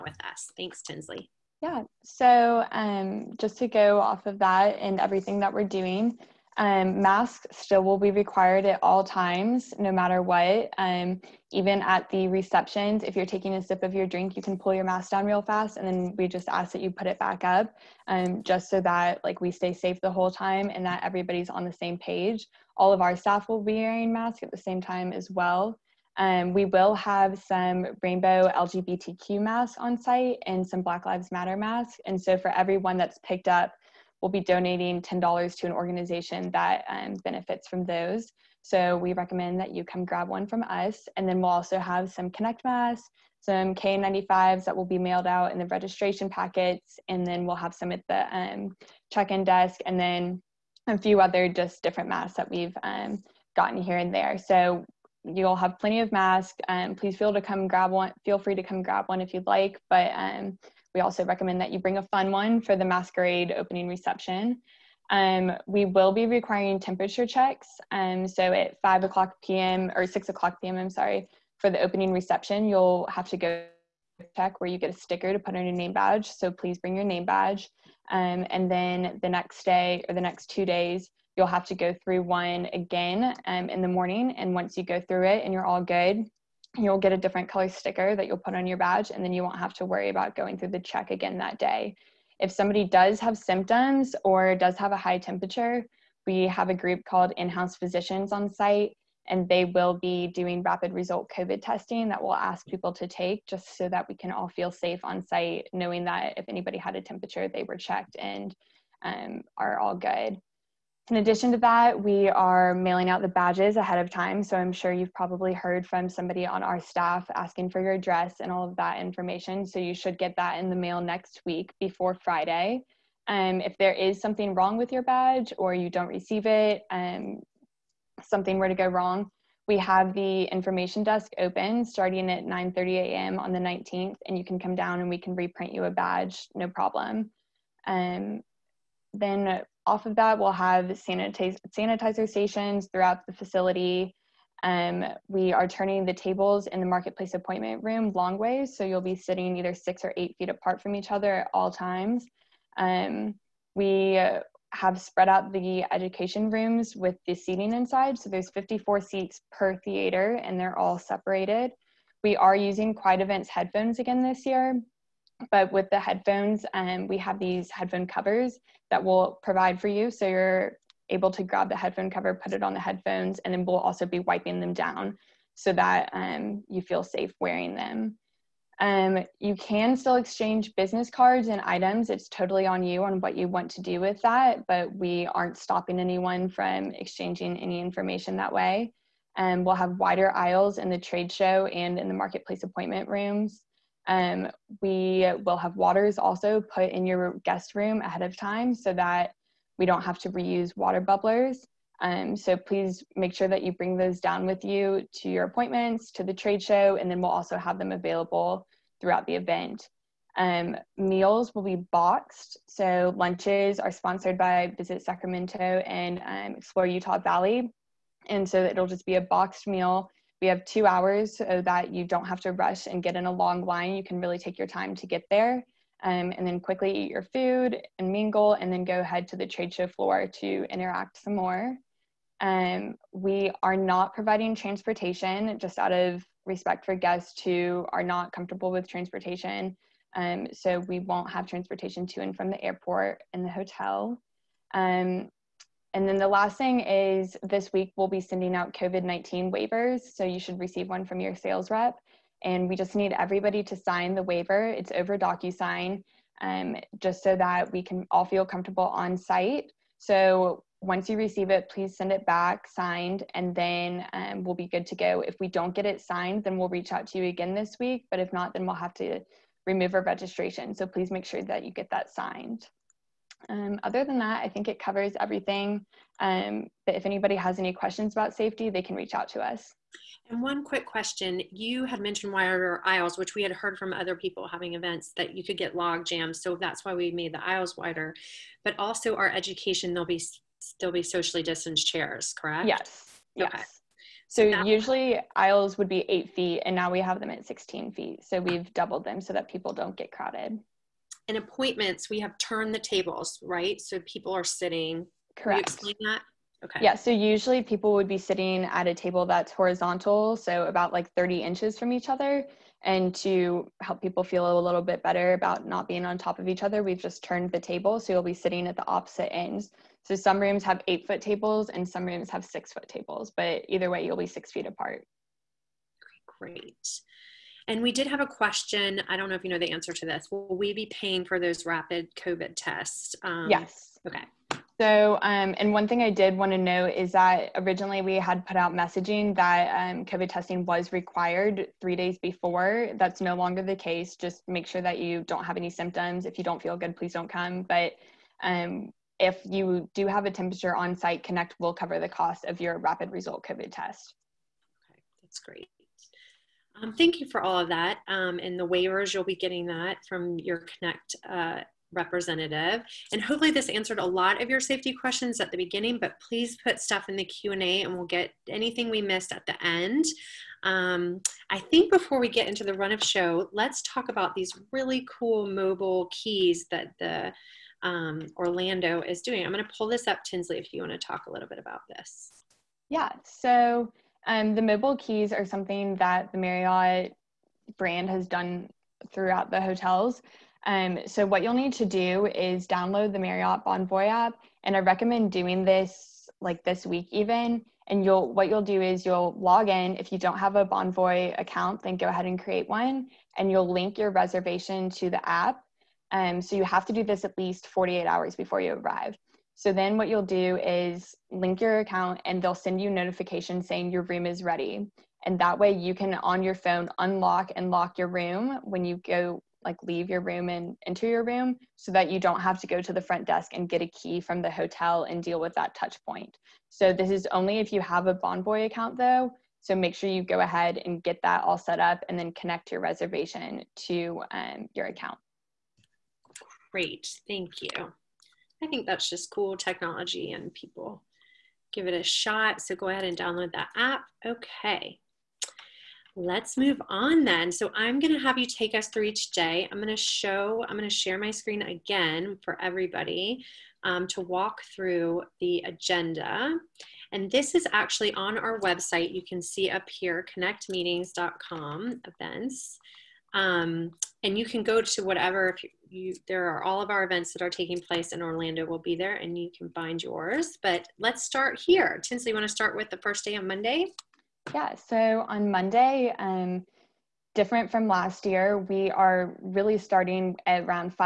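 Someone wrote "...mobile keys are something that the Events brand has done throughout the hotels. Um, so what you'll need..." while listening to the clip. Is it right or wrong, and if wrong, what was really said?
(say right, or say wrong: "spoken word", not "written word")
wrong: "Marriott", not "Events".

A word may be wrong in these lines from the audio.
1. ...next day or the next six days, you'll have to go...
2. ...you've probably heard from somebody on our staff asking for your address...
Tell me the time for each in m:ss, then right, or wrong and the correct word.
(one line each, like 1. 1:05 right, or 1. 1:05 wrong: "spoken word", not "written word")
1. 1:19 wrong: "two", not "six"
2. 1:54 right.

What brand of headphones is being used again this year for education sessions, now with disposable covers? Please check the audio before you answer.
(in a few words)
Quiet Events.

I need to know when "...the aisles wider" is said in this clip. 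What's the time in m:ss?
4:47.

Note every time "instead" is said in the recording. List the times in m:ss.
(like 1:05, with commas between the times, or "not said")
not said.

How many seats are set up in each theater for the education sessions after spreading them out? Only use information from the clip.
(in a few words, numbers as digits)
54.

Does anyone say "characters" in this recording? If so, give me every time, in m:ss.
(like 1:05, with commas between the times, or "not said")
not said.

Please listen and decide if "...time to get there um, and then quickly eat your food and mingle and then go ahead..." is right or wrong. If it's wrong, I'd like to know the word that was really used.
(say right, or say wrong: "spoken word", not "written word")
right.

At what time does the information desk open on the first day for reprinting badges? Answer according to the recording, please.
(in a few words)
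9:30 a.m.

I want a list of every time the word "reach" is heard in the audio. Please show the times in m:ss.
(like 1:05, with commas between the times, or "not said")
4:26, 4:38.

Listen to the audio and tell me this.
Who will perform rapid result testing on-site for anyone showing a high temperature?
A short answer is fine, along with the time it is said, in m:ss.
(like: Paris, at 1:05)
In-house physicians, at 1:37.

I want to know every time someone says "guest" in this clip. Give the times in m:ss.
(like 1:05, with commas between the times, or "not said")
3:17, 3:56.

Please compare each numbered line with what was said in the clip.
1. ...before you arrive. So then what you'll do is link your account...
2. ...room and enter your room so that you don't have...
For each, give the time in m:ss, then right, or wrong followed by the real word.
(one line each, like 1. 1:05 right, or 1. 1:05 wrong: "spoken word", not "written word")
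1. 6:48 right
2. 7:00 right.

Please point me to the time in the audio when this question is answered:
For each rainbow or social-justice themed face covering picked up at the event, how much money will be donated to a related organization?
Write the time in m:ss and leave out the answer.
0:35.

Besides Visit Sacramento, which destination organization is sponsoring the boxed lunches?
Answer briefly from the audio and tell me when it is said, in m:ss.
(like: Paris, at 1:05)
Explore Utah Valley, at 3:36.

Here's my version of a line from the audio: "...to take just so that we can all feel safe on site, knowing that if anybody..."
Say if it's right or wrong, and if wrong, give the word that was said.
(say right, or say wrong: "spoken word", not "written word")
right.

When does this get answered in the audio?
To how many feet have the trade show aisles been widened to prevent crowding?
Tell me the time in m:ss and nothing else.
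4:57.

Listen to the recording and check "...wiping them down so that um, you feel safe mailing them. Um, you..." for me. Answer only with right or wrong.
wrong.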